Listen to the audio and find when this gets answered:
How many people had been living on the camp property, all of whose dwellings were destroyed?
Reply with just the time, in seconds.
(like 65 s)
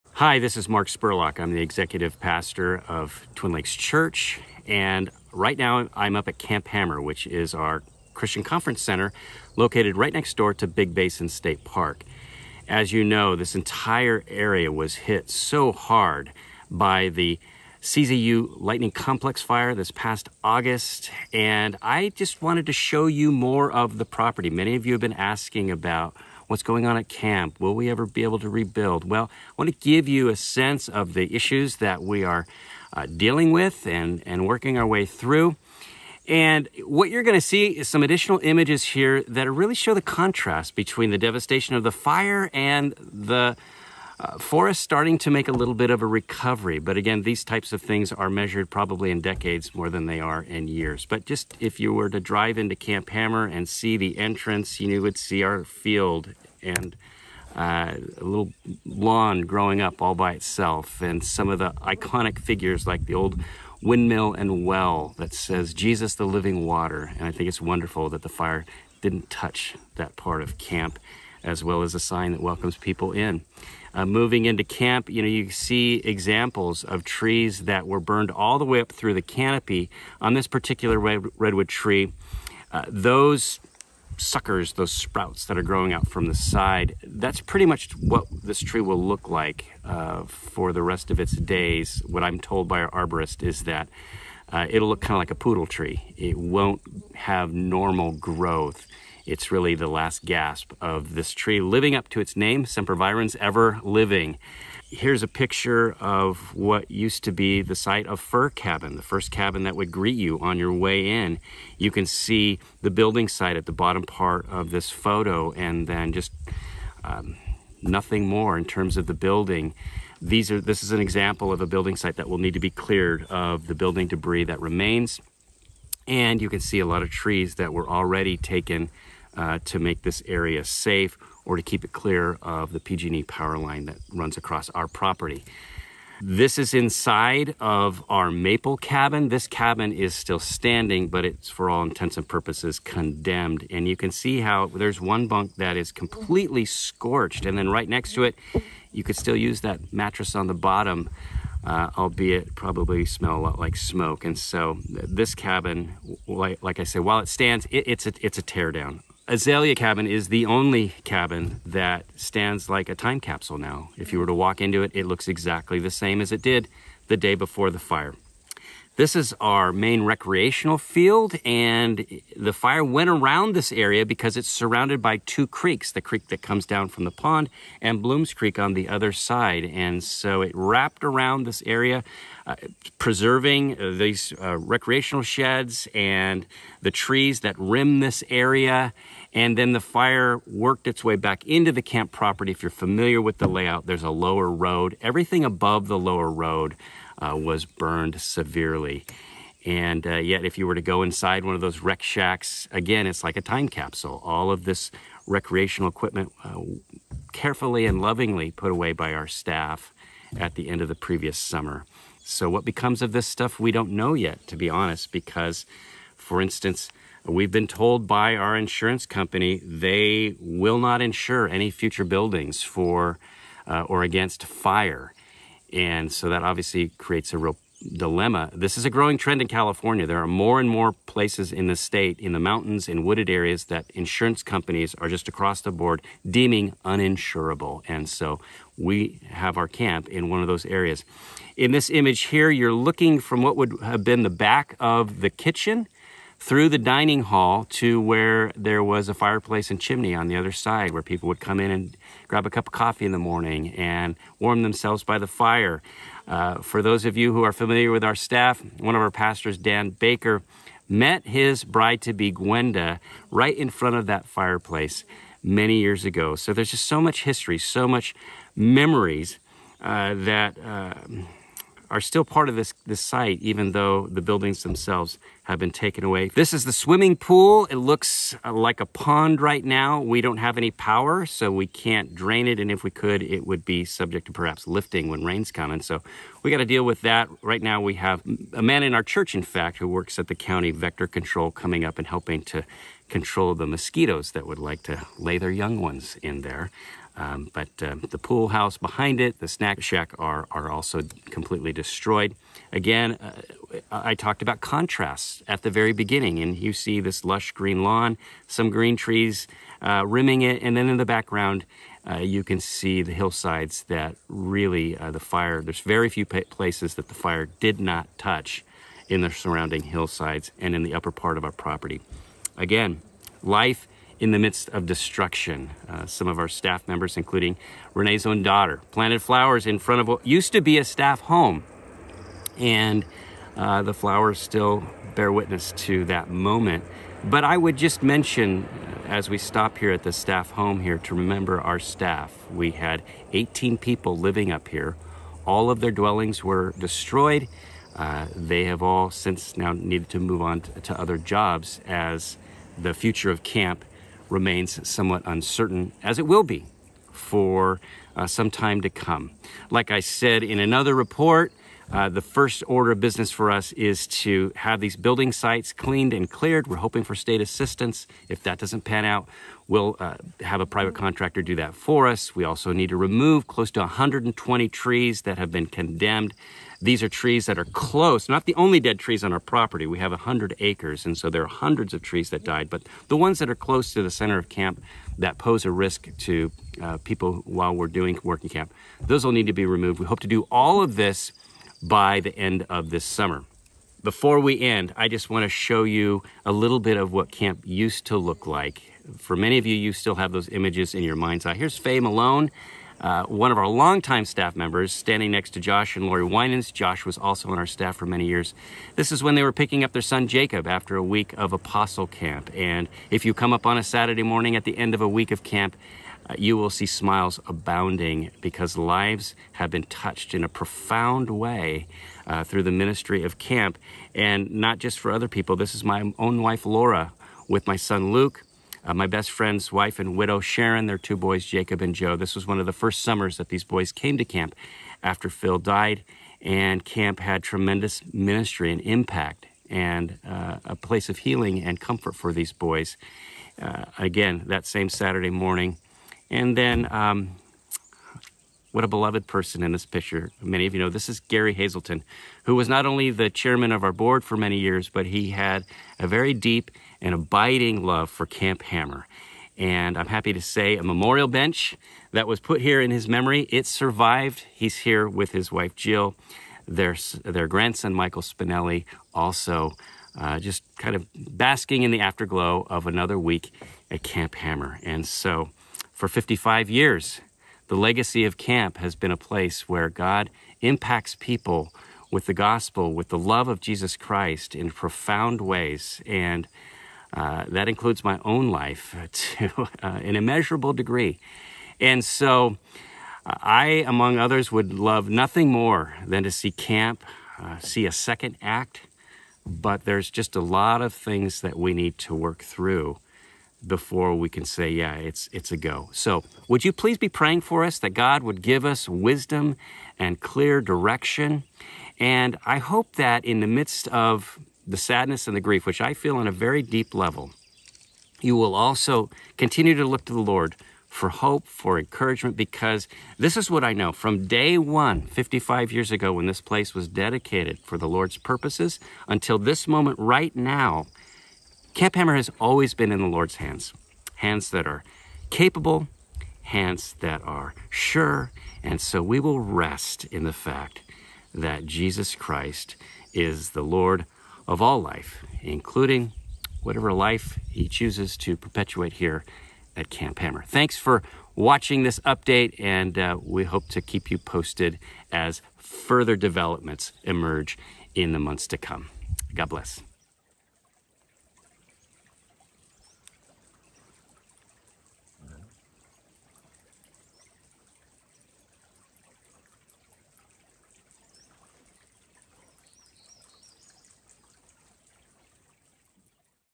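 343 s.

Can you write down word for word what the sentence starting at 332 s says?
And uh, the flowers still bear witness to that moment.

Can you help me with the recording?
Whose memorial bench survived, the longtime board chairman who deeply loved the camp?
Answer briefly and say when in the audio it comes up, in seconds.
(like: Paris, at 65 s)
Gary Hazelton, at 451 s.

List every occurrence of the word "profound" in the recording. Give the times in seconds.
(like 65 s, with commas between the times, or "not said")
420 s, 484 s.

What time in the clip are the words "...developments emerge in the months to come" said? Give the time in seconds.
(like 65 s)
556 s.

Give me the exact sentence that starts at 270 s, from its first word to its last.
Uh, are still part of this, this site, even though the buildings themselves have been taken away.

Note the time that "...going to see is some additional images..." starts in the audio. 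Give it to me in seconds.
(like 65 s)
37 s.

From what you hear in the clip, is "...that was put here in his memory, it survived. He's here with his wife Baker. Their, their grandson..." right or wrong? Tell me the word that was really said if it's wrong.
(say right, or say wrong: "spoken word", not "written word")
wrong: "Jill", not "Baker".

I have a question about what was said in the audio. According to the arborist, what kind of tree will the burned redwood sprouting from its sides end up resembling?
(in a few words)
A poodle tree.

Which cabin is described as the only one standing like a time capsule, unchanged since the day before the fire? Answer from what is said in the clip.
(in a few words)
Azalea Cabin.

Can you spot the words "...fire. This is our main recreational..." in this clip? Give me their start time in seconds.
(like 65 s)
167 s.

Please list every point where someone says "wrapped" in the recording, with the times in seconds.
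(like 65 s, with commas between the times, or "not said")
180 s.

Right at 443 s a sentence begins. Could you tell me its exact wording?
Uh, again, that same Saturday morning.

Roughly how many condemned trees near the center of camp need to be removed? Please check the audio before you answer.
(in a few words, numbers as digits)
120.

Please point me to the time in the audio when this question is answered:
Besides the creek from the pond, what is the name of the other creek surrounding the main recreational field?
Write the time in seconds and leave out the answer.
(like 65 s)
178 s.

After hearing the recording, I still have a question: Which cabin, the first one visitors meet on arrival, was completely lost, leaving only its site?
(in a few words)
Fir Cabin.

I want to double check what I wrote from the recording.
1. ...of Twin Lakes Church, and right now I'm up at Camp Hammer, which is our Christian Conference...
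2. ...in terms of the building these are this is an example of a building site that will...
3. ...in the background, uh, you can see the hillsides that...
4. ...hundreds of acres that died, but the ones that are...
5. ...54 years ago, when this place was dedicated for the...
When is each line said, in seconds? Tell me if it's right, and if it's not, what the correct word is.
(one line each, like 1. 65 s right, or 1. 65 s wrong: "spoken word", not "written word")
1. 2 s right
2. 118 s right
3. 310 s right
4. 381 s wrong: "trees", not "acres"
5. 525 s wrong: "55", not "54".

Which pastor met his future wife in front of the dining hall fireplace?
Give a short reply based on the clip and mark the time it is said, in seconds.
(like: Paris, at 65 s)
Dan Baker, at 259 s.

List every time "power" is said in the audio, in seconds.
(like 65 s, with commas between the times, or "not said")
133 s, 280 s.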